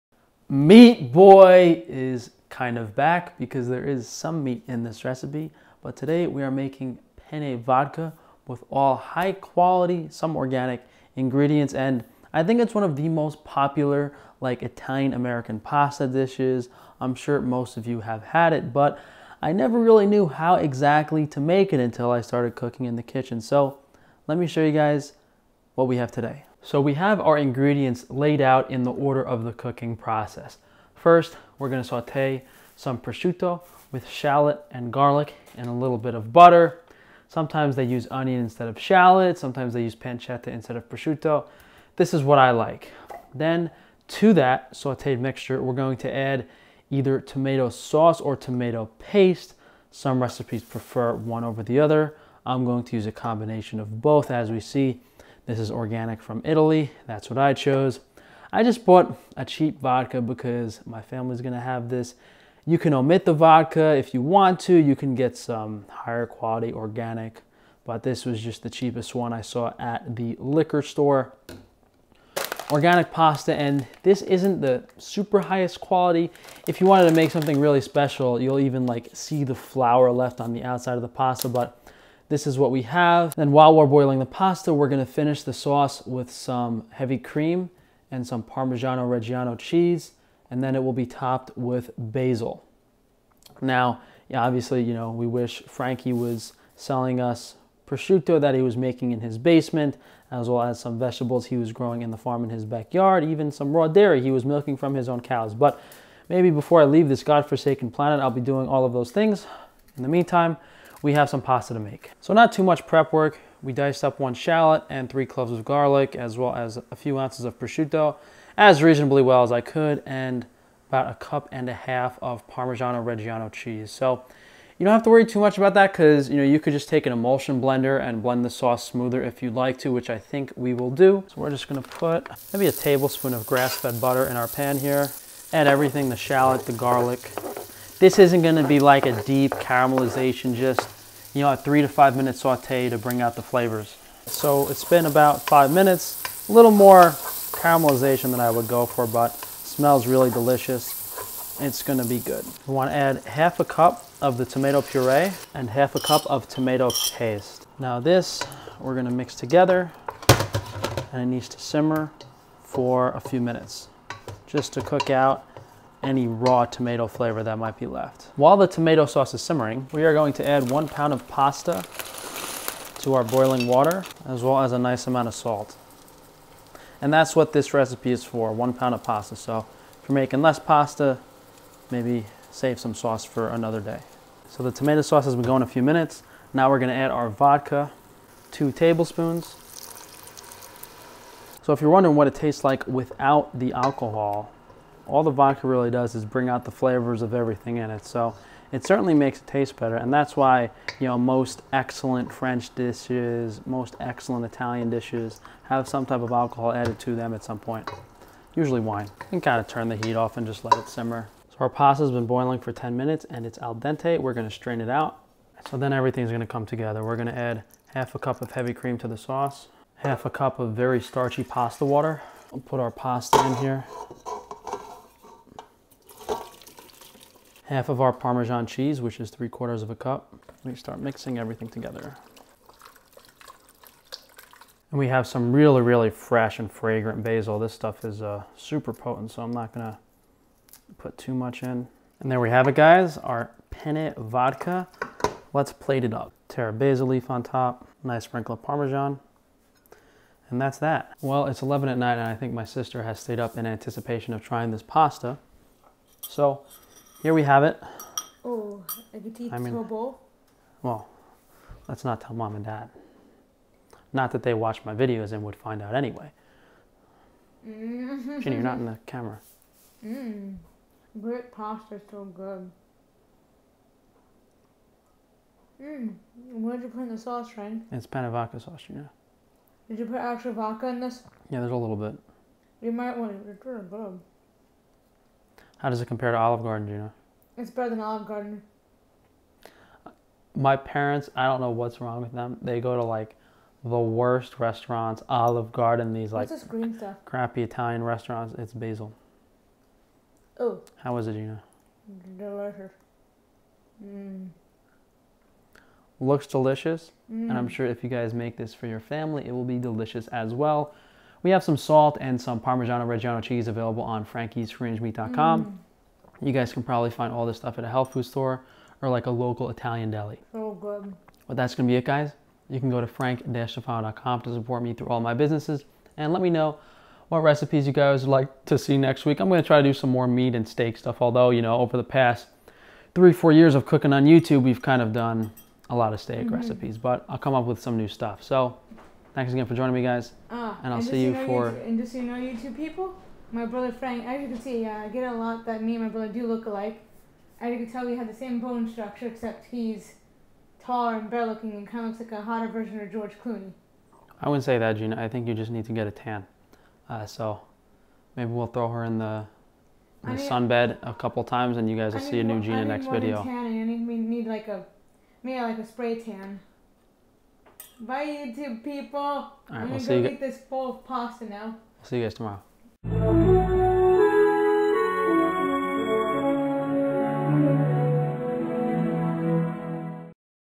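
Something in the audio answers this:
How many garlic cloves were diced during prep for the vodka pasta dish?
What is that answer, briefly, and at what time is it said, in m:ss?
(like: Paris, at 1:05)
3, at 1:55.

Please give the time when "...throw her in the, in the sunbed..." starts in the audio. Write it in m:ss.
5:58.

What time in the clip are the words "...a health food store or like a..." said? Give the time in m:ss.
5:17.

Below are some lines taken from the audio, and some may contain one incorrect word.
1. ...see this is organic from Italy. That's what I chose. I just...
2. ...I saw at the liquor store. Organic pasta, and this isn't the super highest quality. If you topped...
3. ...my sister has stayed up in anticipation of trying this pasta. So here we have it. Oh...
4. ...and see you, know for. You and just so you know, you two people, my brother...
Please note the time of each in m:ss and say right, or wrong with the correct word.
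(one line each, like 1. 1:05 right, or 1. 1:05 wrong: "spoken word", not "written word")
1. 0:54 right
2. 1:09 wrong: "wanted", not "topped"
3. 4:12 right
4. 5:40 right.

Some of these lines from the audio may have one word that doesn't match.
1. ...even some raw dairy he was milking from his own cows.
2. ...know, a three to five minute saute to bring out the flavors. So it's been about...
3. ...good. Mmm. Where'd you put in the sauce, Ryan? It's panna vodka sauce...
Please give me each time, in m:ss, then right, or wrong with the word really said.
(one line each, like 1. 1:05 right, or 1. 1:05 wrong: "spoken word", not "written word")
1. 1:43 right
2. 2:21 right
3. 4:32 right.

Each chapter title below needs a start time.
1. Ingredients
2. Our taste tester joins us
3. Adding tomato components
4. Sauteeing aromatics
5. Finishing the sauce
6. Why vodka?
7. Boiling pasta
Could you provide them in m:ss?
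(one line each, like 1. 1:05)
1. 0:26
2. 4:11
3. 2:32
4. 1:52
5. 3:31
6. 3:04
7. 2:49.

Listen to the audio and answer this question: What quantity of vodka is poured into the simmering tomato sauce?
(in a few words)
2 tablespoons.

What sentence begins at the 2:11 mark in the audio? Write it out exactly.
So we're just gonna put maybe a tablespoon of grass-fed butter in our pan here.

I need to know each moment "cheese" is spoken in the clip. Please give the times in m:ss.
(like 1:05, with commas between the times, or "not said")
1:29, 2:03, 3:48, 5:13.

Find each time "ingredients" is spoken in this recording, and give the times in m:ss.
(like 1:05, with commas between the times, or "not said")
0:11, 0:27.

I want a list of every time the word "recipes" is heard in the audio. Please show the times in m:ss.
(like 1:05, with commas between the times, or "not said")
0:05, 0:50, 2:57, 5:27, 5:36.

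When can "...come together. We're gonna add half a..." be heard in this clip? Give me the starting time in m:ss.
3:36.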